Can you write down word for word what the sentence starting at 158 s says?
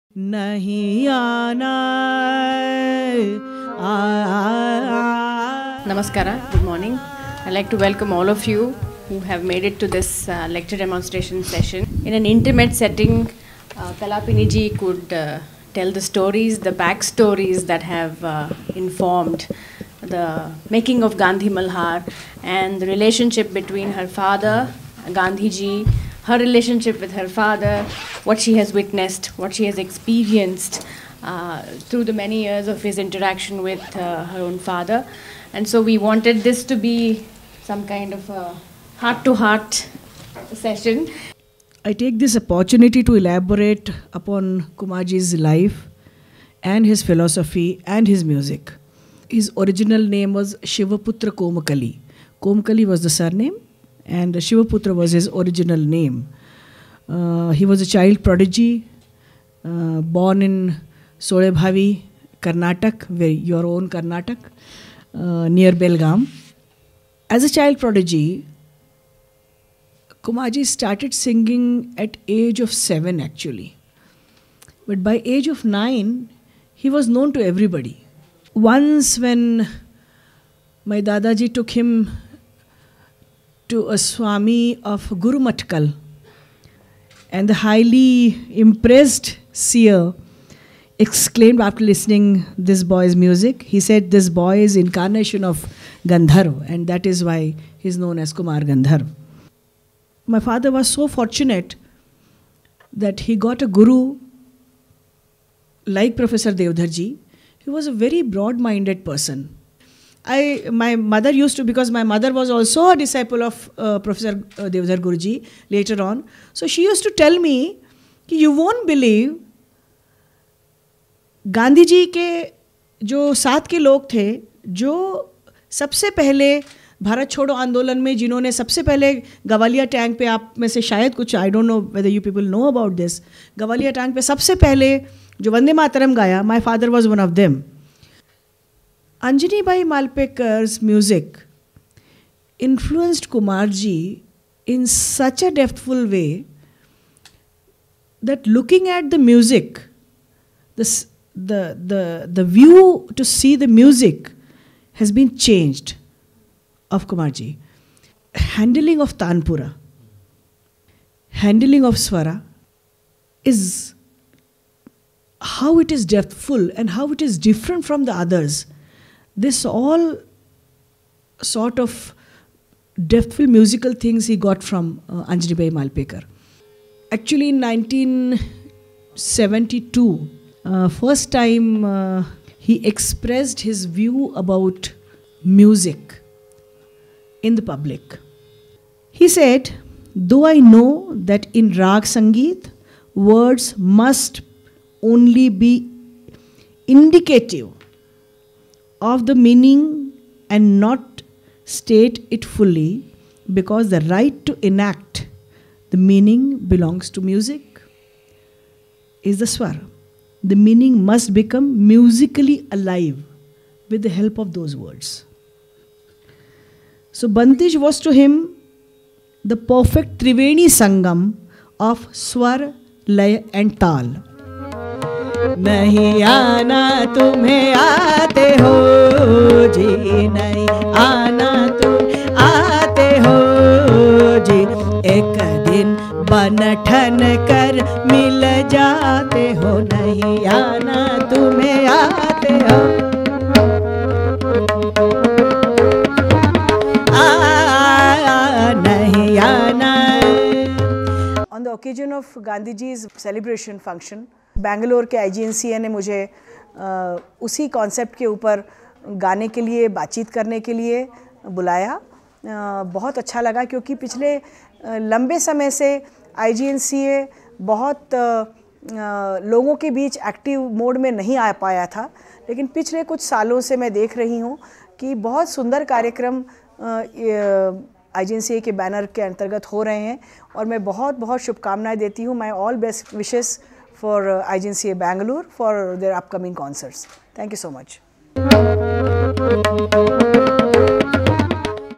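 Handling of Tanpura, handling of Swara is how it is depthful and how it is different from the others.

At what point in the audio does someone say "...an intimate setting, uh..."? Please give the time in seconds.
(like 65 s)
12 s.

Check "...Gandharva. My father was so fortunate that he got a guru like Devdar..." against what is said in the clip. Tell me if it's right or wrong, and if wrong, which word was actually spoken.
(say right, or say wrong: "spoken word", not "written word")
wrong: "Professor", not "Devdar".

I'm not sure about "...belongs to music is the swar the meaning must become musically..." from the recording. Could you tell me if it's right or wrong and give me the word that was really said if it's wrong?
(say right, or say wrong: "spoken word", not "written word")
right.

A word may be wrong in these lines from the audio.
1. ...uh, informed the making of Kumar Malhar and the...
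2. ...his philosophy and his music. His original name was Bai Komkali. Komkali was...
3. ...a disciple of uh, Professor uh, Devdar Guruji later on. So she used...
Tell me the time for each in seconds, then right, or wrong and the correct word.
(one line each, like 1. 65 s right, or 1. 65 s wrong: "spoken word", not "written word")
1. 18 s wrong: "Gandhi", not "Kumar"
2. 46 s wrong: "Shivaputra", not "Bai"
3. 112 s right.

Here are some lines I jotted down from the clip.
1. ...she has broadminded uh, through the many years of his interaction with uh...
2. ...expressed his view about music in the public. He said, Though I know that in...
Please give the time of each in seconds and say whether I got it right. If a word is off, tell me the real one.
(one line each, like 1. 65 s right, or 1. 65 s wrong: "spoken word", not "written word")
1. 29 s wrong: "experienced", not "broadminded"
2. 182 s right.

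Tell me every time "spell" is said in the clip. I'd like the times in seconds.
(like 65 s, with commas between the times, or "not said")
not said.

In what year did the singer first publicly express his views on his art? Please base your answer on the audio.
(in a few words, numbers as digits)
1972.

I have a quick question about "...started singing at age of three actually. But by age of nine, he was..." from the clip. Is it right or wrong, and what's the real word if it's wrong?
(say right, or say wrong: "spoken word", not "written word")
wrong: "seven", not "three".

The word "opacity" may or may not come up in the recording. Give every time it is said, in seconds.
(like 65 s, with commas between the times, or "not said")
not said.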